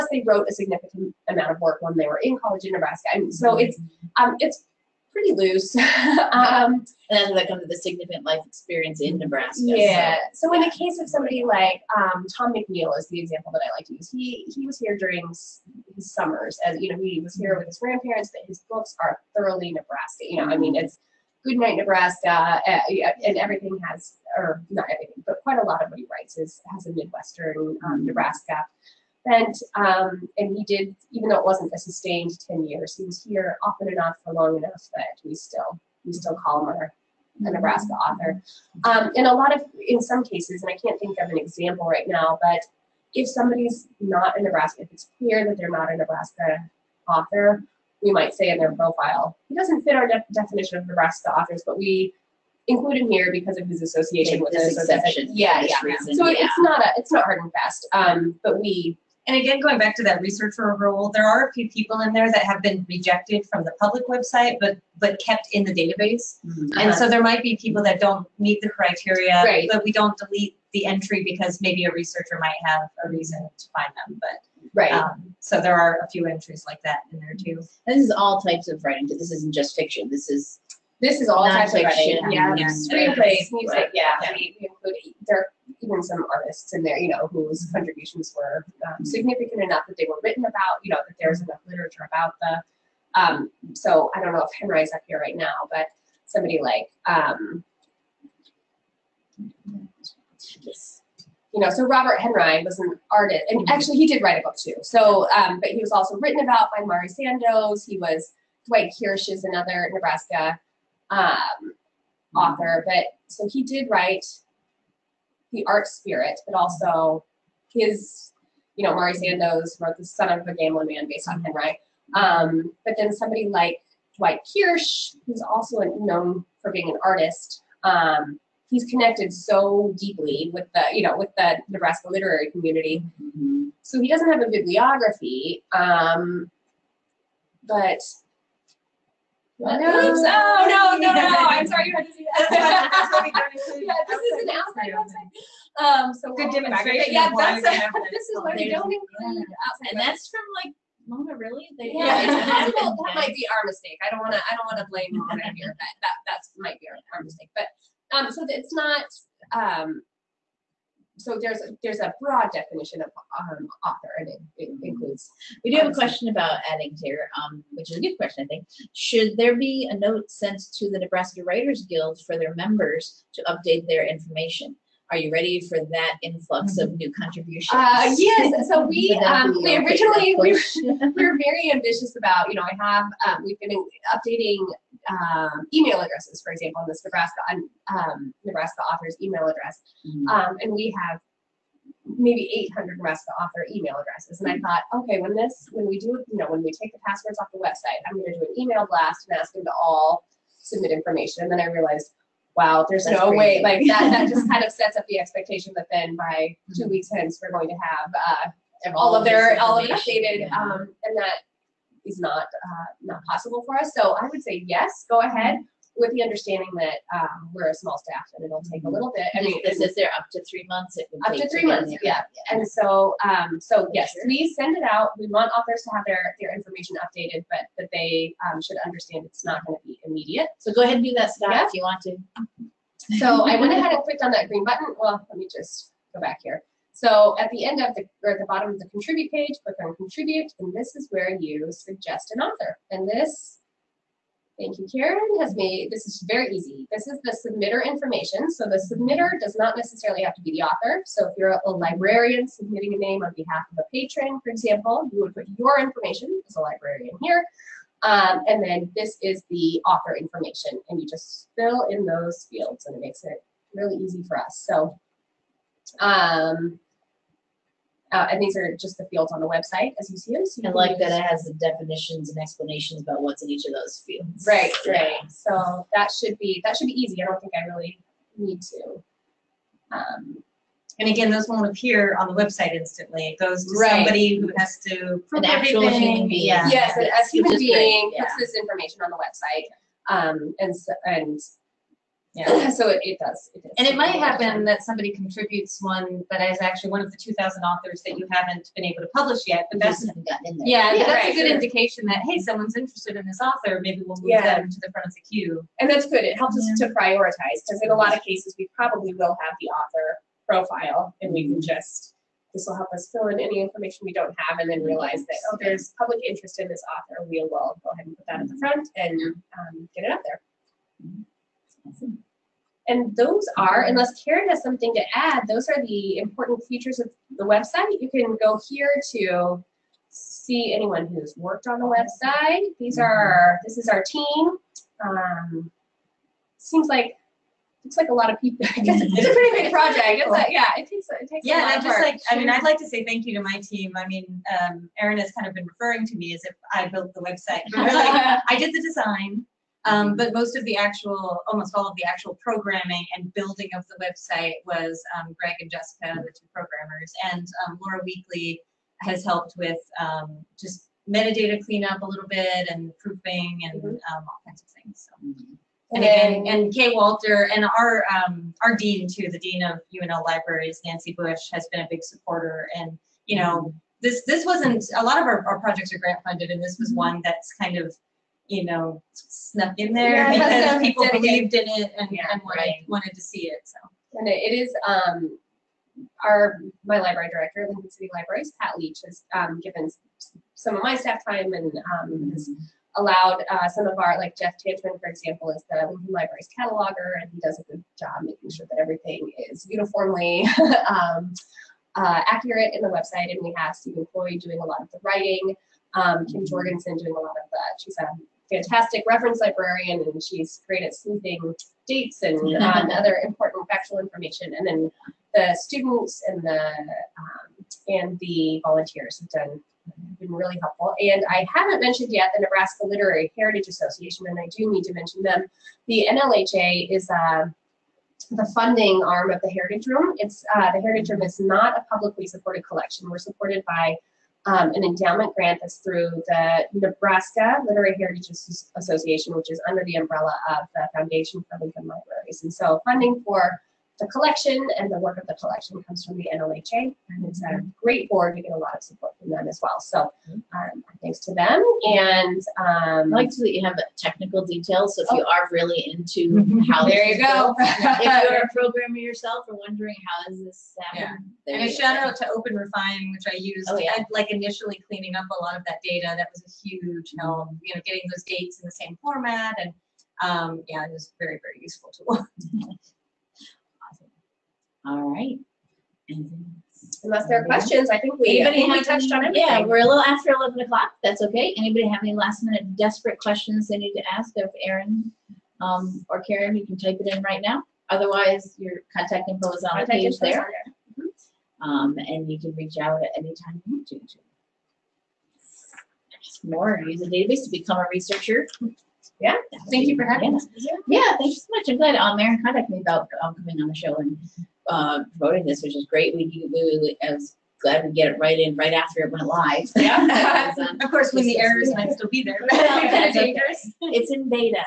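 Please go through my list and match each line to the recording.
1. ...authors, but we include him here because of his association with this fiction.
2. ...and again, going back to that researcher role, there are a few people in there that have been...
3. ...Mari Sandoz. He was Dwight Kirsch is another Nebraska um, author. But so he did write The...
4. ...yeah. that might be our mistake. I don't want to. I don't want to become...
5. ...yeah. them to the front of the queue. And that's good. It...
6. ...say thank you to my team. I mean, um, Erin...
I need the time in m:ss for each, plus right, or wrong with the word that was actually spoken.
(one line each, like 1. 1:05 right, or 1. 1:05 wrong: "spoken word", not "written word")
1. 0:51 wrong: "exception", not "fiction"
2. 0:59 right
3. 1:46 right
4. 2:32 wrong: "blame", not "become"
5. 5:04 right
6. 5:42 right.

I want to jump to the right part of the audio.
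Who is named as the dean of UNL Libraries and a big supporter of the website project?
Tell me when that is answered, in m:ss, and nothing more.
6:10.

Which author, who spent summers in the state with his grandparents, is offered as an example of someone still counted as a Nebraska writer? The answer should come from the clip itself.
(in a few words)
Tom McNeal.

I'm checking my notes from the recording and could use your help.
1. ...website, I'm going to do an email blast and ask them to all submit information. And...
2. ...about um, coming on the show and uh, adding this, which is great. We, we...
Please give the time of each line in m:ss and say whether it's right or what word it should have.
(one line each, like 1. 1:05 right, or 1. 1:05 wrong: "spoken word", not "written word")
1. 3:17 right
2. 8:22 wrong: "promoting", not "adding".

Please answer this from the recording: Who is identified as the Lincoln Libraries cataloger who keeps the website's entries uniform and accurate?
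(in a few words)
Jeff Tantman.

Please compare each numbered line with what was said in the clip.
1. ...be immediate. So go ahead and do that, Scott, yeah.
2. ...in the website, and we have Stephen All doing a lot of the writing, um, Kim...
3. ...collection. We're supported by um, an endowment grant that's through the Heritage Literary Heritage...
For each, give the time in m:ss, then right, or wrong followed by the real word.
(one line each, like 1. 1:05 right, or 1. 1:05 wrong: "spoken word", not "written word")
1. 3:49 right
2. 6:42 wrong: "Coy", not "All"
3. 7:12 wrong: "Nebraska", not "Heritage".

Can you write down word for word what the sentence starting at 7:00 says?
And I haven't mentioned yet the Nebraska Literary Heritage Association, and I do need to mention them.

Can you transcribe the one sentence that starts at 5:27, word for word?
You can go here to see anyone who's worked on the website.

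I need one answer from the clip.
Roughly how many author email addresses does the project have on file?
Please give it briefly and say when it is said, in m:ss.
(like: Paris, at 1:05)
800, at 3:12.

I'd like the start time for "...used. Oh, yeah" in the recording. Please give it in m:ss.
7:43.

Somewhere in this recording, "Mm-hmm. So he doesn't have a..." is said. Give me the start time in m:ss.
2:13.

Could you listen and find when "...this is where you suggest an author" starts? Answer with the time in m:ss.
4:00.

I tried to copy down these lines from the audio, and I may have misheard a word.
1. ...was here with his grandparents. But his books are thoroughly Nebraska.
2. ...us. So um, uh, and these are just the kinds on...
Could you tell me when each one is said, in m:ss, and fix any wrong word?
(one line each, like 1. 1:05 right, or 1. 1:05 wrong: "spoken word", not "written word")
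1. 0:17 right
2. 4:24 wrong: "fields", not "kinds".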